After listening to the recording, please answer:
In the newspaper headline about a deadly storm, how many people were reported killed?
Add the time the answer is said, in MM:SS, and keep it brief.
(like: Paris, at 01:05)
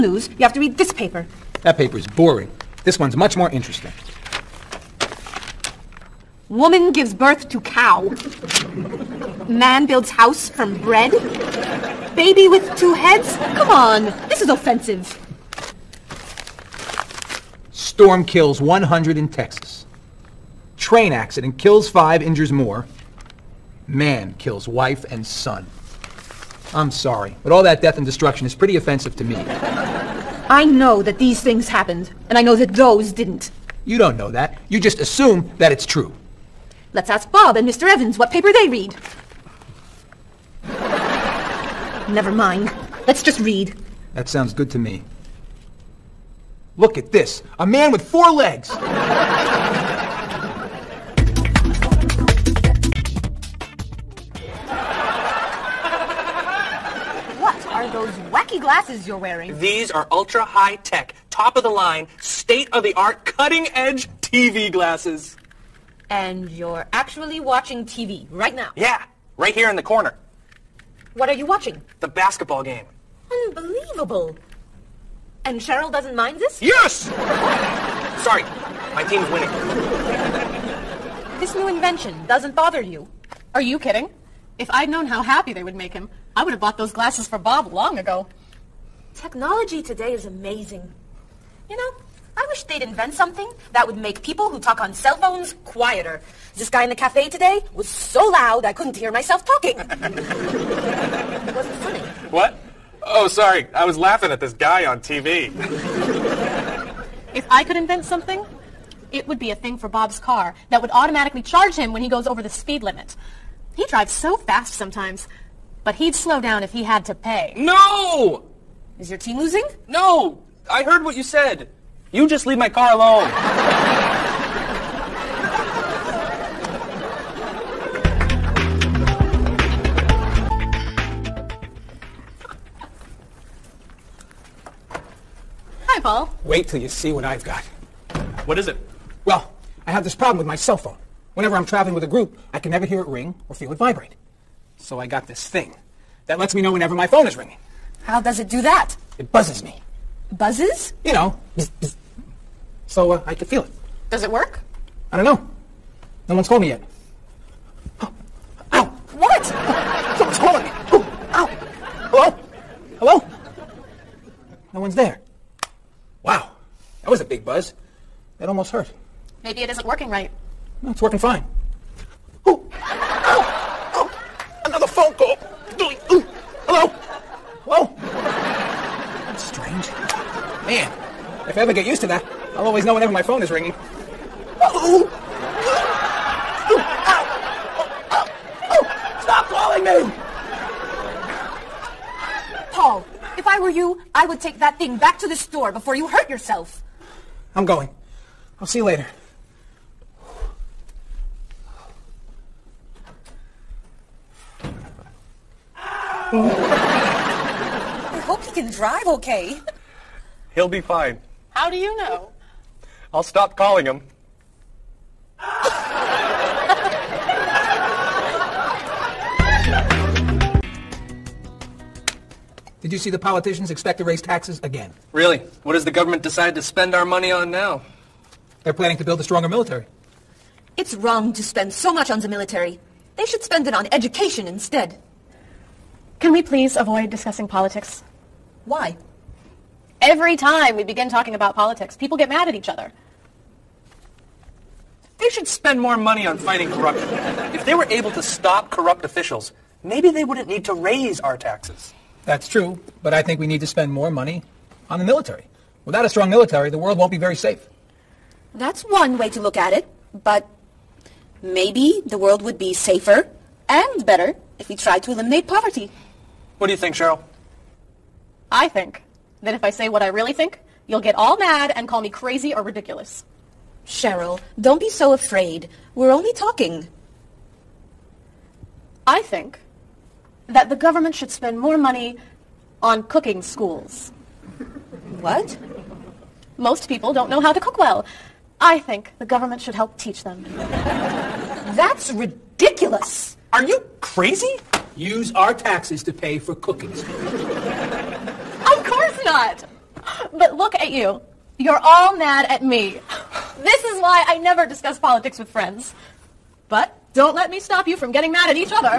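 100, at 00:17.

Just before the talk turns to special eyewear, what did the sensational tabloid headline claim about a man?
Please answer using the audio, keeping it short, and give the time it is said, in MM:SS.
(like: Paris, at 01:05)
A man with four legs, at 00:47.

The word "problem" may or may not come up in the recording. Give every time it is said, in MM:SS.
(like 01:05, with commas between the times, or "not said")
02:20.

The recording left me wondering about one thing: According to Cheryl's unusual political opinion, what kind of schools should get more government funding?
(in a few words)
Cooking schools.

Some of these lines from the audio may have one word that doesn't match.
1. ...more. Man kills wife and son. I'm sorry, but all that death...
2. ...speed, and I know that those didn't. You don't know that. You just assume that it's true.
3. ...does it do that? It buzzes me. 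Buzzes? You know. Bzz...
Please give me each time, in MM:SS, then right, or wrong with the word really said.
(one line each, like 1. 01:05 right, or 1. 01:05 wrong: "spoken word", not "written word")
1. 00:22 right
2. 00:31 wrong: "happened", not "speed"
3. 02:28 right.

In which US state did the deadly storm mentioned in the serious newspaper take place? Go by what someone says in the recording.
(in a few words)
Texas.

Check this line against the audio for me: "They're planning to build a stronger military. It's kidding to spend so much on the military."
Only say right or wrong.
wrong.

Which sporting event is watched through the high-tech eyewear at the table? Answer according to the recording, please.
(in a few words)
The basketball game.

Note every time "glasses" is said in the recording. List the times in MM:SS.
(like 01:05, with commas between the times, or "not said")
00:58, 01:04, 01:26.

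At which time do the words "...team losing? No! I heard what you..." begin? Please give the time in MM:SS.
01:59.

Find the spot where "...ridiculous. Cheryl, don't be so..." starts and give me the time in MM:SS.
04:32.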